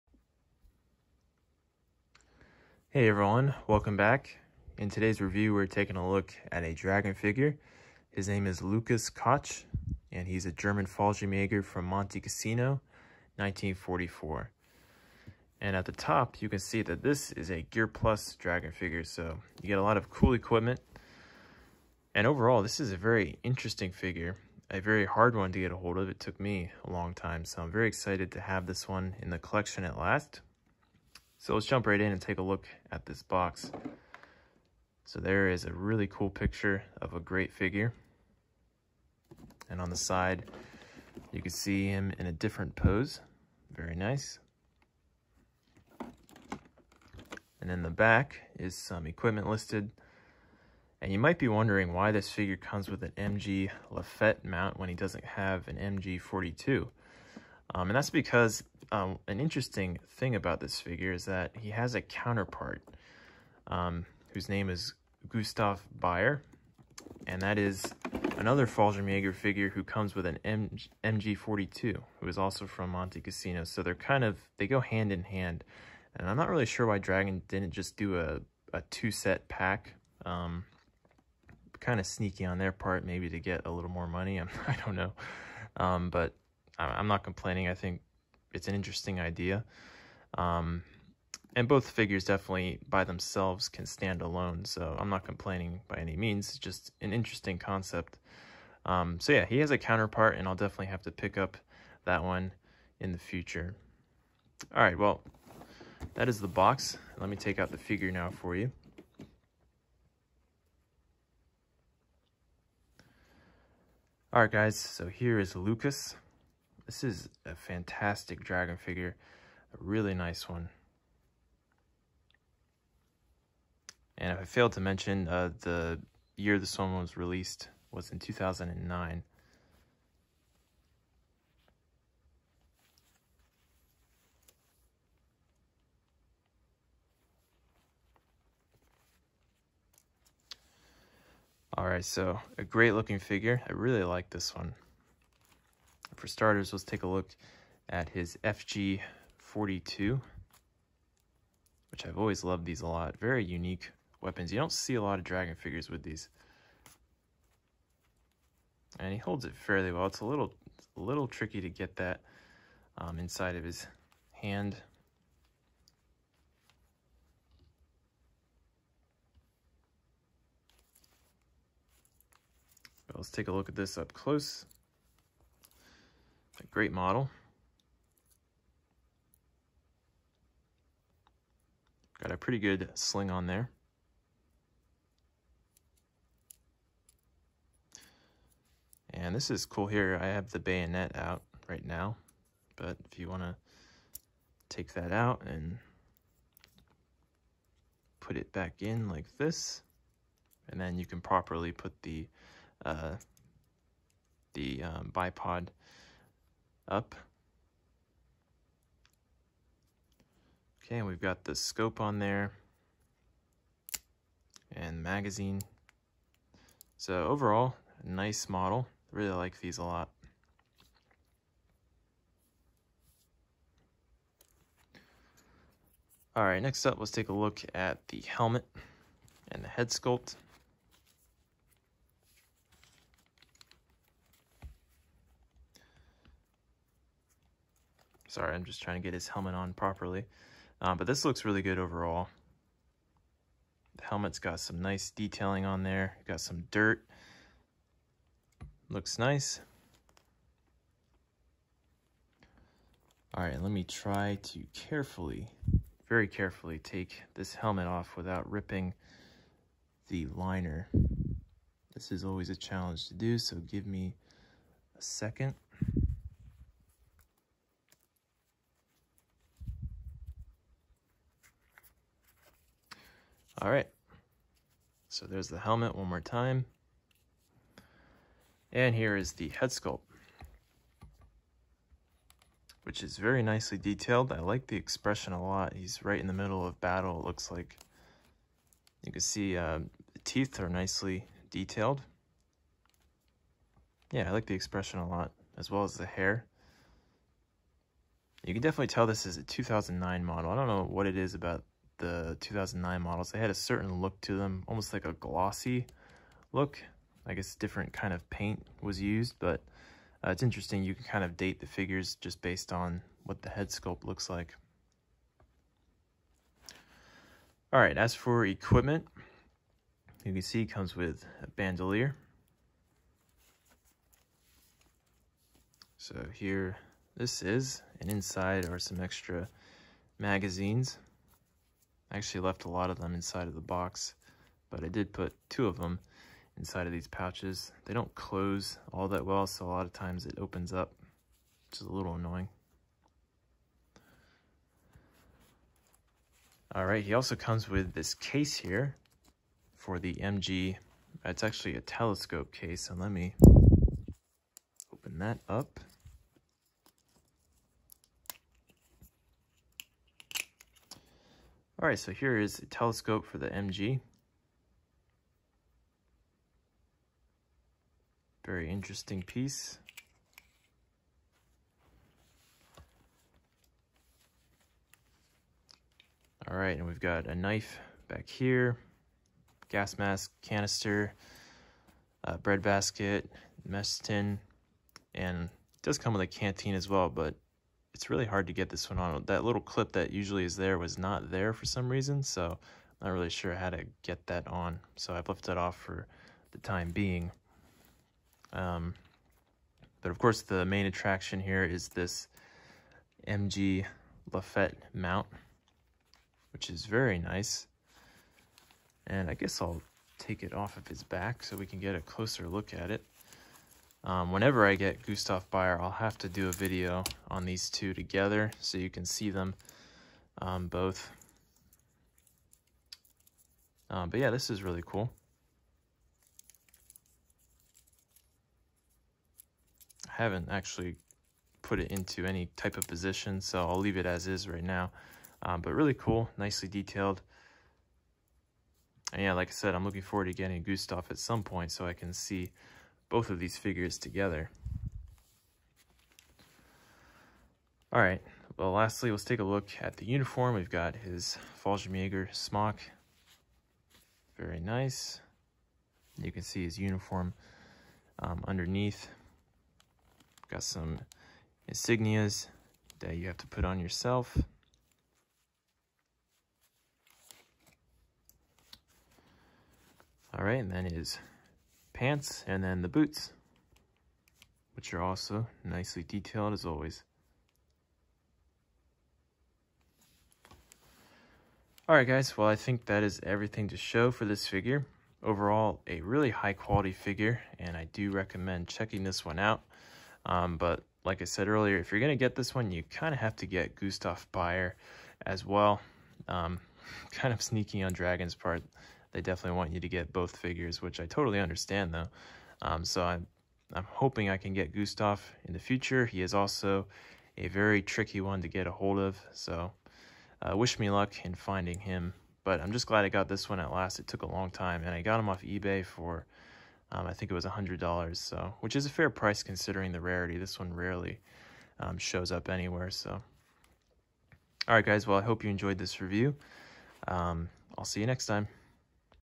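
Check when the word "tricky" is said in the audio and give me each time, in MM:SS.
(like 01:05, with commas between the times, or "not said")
02:41, 08:27.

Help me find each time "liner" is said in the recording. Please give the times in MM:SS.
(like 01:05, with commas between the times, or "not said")
04:20.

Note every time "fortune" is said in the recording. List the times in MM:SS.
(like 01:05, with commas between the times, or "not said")
not said.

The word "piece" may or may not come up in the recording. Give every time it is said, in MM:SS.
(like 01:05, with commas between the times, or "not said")
06:09.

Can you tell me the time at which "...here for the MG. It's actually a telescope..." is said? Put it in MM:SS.
05:48.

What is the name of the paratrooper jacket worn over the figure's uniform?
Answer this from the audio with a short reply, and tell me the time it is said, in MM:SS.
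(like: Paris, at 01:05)
Fallschirmjäger smock, at 07:31.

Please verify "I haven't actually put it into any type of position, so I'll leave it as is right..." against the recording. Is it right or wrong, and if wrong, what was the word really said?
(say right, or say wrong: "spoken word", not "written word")
right.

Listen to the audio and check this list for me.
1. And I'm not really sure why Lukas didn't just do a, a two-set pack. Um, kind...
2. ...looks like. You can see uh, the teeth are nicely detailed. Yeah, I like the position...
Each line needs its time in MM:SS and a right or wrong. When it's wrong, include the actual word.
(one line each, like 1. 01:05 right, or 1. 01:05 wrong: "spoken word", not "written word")
1. 01:16 wrong: "Dragon", not "Lukas"
2. 04:47 wrong: "expression", not "position".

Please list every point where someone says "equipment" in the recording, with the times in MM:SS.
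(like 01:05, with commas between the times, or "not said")
00:20, 00:49, 05:18.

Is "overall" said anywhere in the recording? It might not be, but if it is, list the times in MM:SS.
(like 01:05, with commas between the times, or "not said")
00:22, 03:37, 04:01, 08:05.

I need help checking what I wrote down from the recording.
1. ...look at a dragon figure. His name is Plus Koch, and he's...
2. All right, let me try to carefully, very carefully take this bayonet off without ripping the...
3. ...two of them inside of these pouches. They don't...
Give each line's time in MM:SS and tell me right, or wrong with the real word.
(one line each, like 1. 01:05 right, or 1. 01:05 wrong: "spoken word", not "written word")
1. 00:06 wrong: "Lukas", not "Plus"
2. 04:13 wrong: "helmet", not "bayonet"
3. 05:35 right.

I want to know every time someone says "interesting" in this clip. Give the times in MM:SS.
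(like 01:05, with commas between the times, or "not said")
00:23, 00:59, 01:28, 01:37, 05:10, 06:08.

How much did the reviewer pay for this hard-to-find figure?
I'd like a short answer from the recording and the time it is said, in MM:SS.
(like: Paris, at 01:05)
$100, at 08:37.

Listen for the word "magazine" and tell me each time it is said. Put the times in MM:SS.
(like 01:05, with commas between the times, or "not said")
03:35, 05:30.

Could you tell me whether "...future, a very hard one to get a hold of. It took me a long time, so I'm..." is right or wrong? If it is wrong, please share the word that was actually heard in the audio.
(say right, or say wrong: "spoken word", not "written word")
wrong: "figure", not "future".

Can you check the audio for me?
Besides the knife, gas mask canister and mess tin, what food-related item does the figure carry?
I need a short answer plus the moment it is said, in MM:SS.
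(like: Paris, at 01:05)
Bread basket, at 06:22.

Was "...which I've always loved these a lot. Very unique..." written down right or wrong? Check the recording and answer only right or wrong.
right.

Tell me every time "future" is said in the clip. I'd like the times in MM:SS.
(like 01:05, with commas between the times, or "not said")
01:43, 08:25.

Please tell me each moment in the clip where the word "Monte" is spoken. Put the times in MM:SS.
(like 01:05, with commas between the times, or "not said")
00:11, 01:12.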